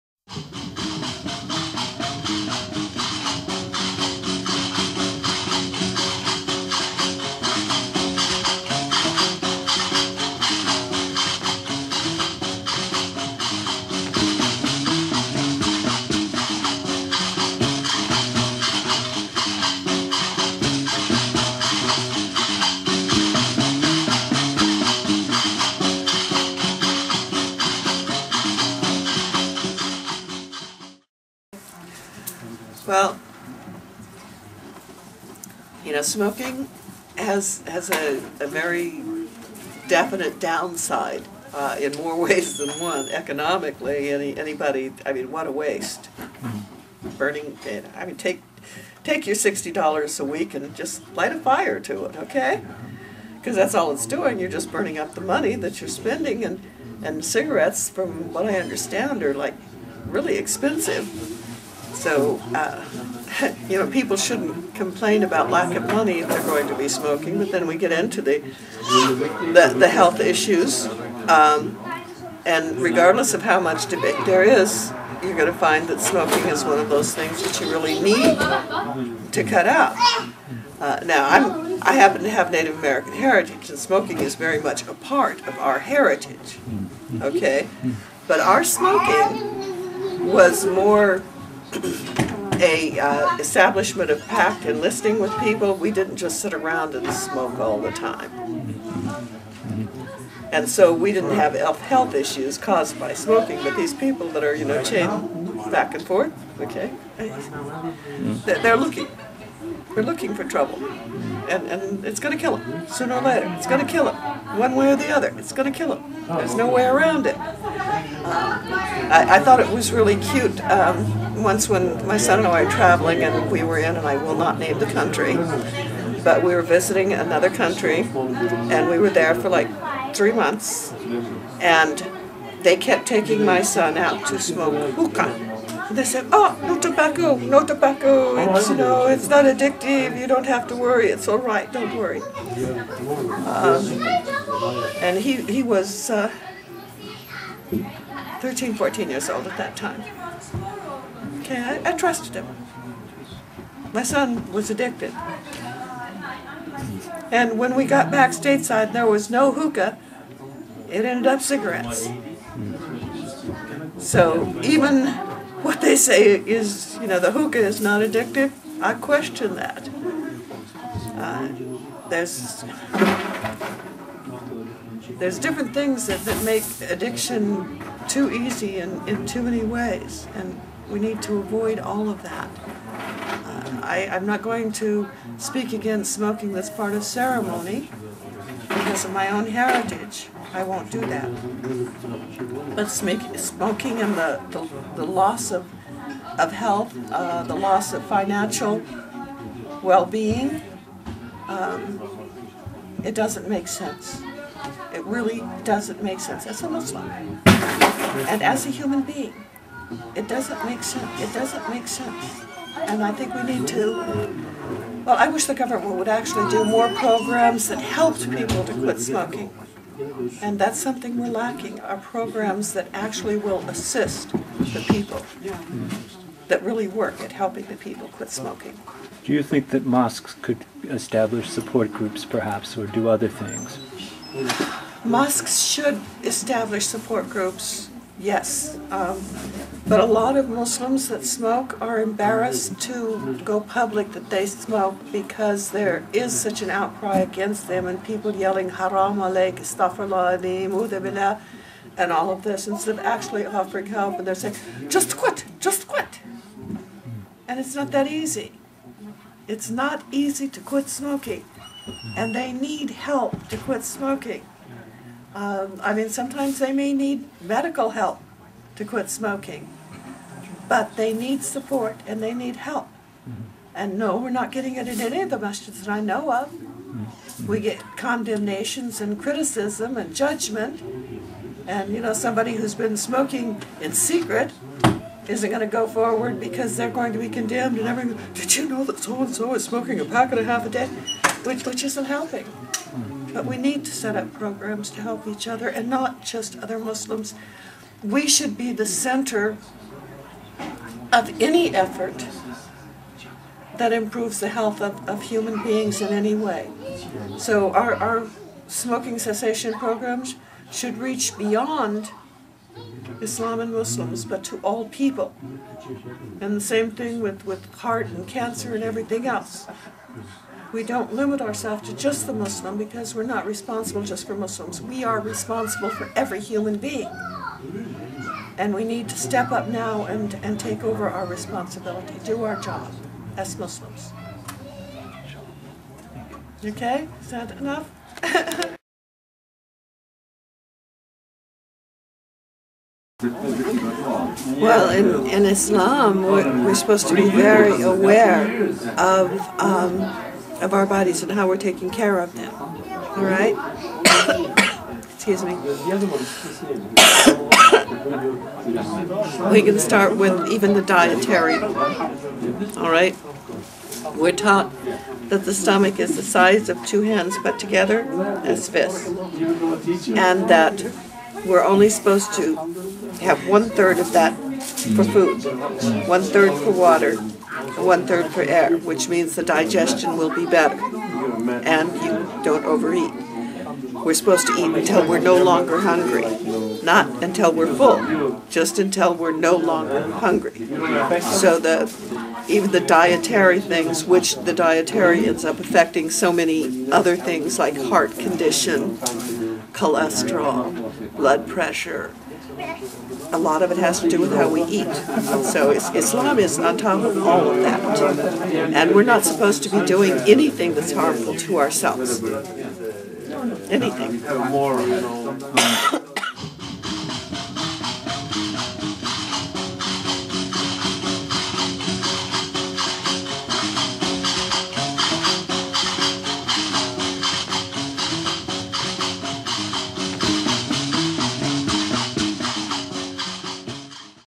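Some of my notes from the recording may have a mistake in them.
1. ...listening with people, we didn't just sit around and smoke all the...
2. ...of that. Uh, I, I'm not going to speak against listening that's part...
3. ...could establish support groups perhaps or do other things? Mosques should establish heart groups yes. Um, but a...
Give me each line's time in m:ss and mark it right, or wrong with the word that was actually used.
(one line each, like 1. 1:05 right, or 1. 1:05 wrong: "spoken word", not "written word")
1. 1:34 right
2. 3:02 wrong: "smoking", not "listening"
3. 3:50 wrong: "support", not "heart".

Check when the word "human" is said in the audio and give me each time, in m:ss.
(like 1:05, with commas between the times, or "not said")
3:28, 5:05, 5:26.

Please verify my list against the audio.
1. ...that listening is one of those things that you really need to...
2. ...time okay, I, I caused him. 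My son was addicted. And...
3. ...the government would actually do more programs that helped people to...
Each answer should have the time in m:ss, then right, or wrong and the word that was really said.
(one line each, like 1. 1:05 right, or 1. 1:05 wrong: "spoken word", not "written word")
1. 1:15 wrong: "smoking", not "listening"
2. 2:29 wrong: "trusted", not "caused"
3. 3:35 right.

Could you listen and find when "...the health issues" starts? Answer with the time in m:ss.
1:09.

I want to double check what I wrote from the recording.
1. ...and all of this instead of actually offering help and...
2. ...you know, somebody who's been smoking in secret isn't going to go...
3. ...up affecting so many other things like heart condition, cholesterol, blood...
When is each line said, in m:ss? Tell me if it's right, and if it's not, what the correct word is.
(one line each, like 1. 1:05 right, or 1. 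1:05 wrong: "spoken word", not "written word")
1. 4:11 right
2. 4:41 right
3. 6:35 right.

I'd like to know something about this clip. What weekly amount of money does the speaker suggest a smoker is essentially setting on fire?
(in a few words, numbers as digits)
$60.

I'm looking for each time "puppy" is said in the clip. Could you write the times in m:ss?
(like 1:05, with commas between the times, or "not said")
not said.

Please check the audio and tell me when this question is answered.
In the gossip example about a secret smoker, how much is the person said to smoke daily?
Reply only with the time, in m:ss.
4:50.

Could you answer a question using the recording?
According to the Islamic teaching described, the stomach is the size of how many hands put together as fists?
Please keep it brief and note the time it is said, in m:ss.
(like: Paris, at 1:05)
2, at 6:06.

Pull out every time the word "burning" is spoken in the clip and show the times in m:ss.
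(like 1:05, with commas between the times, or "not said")
0:47, 0:54.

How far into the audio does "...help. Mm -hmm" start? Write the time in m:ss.
4:32.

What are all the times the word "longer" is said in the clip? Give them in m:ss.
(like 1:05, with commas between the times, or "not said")
6:25, 6:29.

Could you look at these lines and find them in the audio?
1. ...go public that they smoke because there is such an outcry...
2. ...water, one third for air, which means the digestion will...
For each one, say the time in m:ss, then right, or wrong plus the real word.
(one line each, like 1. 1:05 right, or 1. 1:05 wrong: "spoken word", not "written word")
1. 4:03 right
2. 6:16 right.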